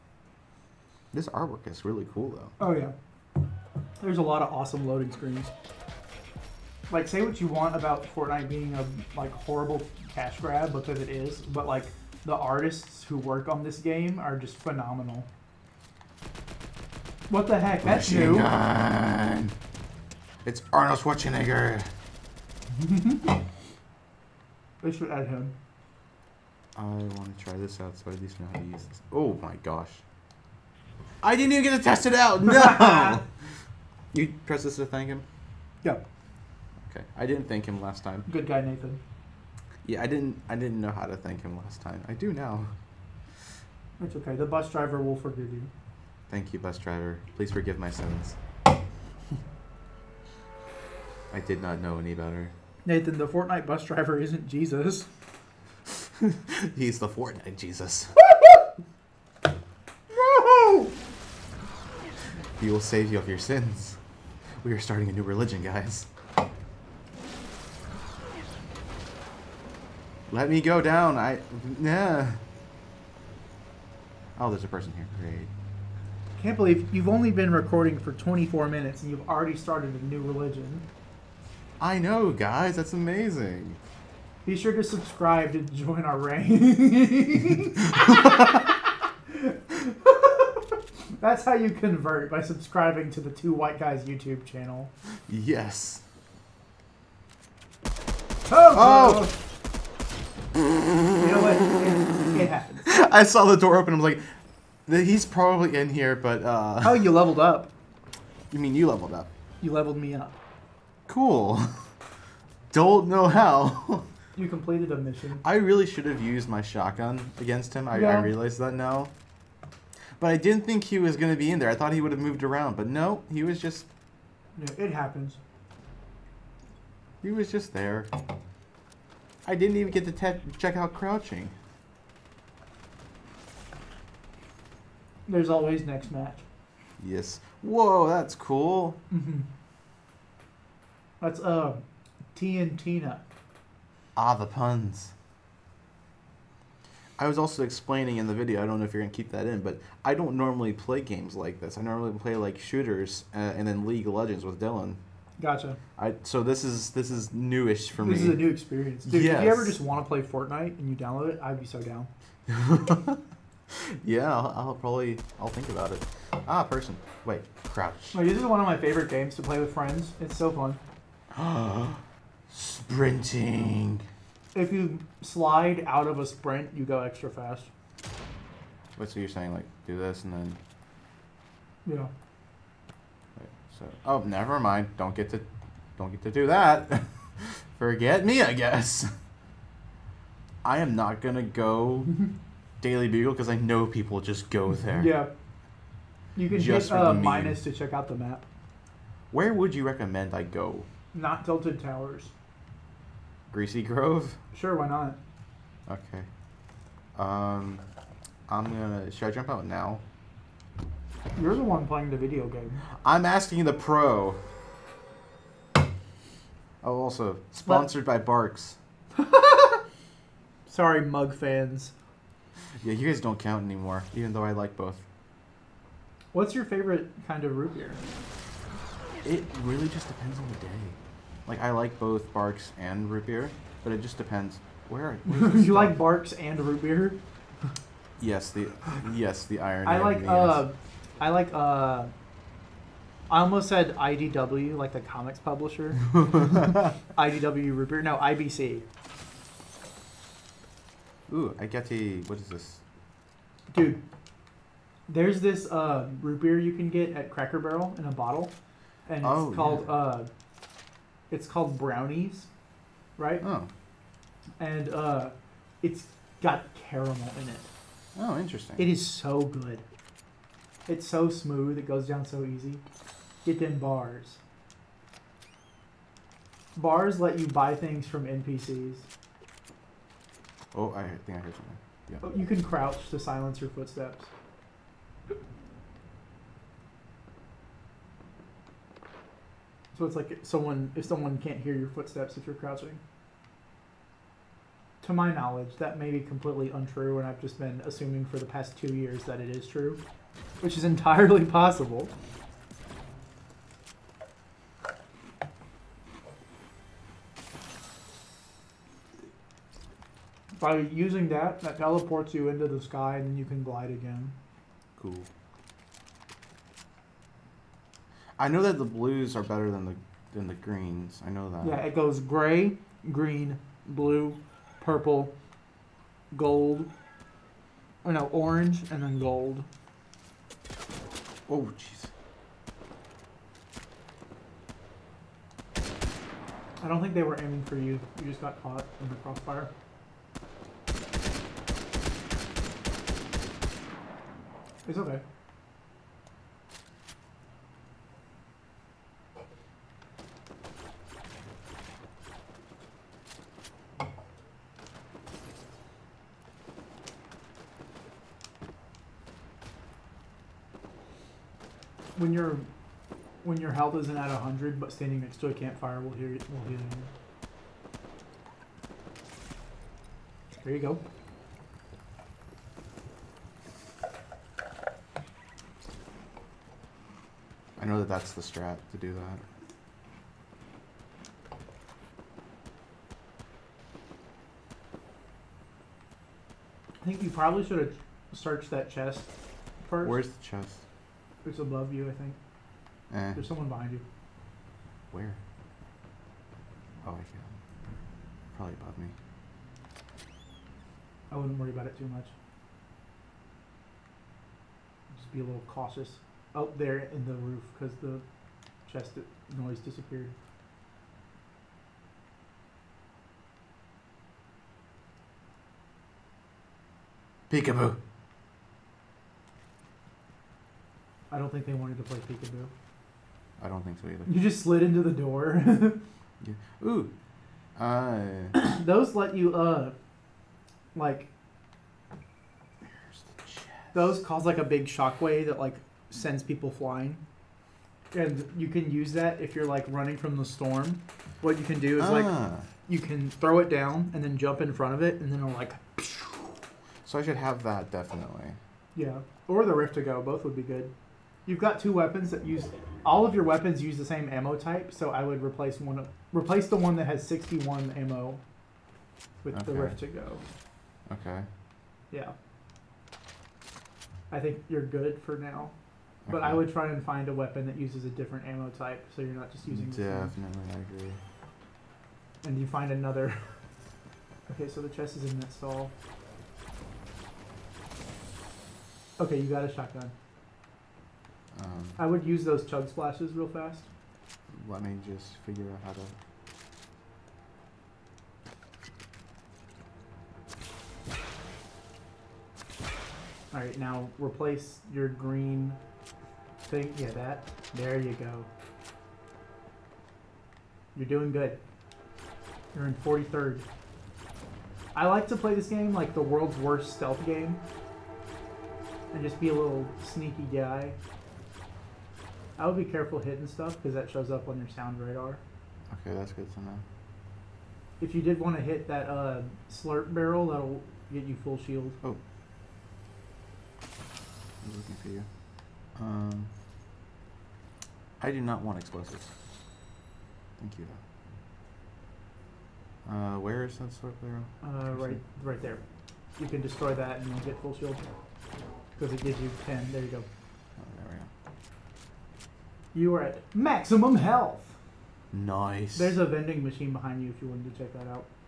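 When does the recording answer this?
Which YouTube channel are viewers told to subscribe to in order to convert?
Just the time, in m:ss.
1:33.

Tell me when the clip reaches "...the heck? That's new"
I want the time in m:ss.
0:17.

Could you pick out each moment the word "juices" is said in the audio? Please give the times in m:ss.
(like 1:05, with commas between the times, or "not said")
not said.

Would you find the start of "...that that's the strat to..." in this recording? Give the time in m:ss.
6:17.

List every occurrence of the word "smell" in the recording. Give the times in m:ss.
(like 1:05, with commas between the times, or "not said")
not said.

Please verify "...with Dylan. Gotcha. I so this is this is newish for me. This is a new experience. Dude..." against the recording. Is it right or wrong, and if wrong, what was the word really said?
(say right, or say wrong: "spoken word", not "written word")
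right.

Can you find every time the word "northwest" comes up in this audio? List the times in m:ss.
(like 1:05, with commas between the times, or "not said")
not said.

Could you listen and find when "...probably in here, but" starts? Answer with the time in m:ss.
1:45.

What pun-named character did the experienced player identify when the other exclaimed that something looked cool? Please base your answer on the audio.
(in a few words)
TNTina.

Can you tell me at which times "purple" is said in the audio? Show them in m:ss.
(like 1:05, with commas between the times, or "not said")
5:24.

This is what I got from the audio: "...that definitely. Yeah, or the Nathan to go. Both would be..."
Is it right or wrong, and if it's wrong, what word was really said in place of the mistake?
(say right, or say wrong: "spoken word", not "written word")
wrong: "Rift", not "Nathan".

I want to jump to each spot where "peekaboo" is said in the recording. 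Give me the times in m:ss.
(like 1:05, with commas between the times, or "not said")
6:57, 7:02.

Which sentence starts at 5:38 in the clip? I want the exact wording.
You just got caught in the crossfire.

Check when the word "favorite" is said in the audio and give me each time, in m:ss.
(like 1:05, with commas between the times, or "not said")
2:48, 3:46.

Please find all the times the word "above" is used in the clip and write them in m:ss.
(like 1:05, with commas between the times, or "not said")
6:31, 6:38.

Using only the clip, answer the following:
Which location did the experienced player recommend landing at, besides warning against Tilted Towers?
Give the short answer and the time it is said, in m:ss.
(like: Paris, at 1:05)
Greasy Grove, at 3:23.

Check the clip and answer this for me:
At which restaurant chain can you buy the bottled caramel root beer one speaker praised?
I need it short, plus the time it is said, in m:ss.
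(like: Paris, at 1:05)
Cracker Barrel, at 4:17.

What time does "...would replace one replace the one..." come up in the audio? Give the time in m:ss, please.
7:35.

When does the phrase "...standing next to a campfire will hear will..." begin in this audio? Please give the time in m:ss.
6:04.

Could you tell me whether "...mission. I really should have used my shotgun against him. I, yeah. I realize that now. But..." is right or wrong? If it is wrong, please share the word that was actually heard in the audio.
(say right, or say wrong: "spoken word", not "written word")
right.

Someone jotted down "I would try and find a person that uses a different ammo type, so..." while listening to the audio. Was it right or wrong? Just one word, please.
wrong.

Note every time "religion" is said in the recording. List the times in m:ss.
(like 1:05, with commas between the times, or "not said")
1:05, 1:20.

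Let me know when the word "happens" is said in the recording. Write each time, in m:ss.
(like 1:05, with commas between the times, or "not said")
1:42, 2:04.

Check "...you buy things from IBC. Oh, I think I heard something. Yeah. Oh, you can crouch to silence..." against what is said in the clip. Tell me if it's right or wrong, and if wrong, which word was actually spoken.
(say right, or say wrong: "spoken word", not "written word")
wrong: "NPCs", not "IBC".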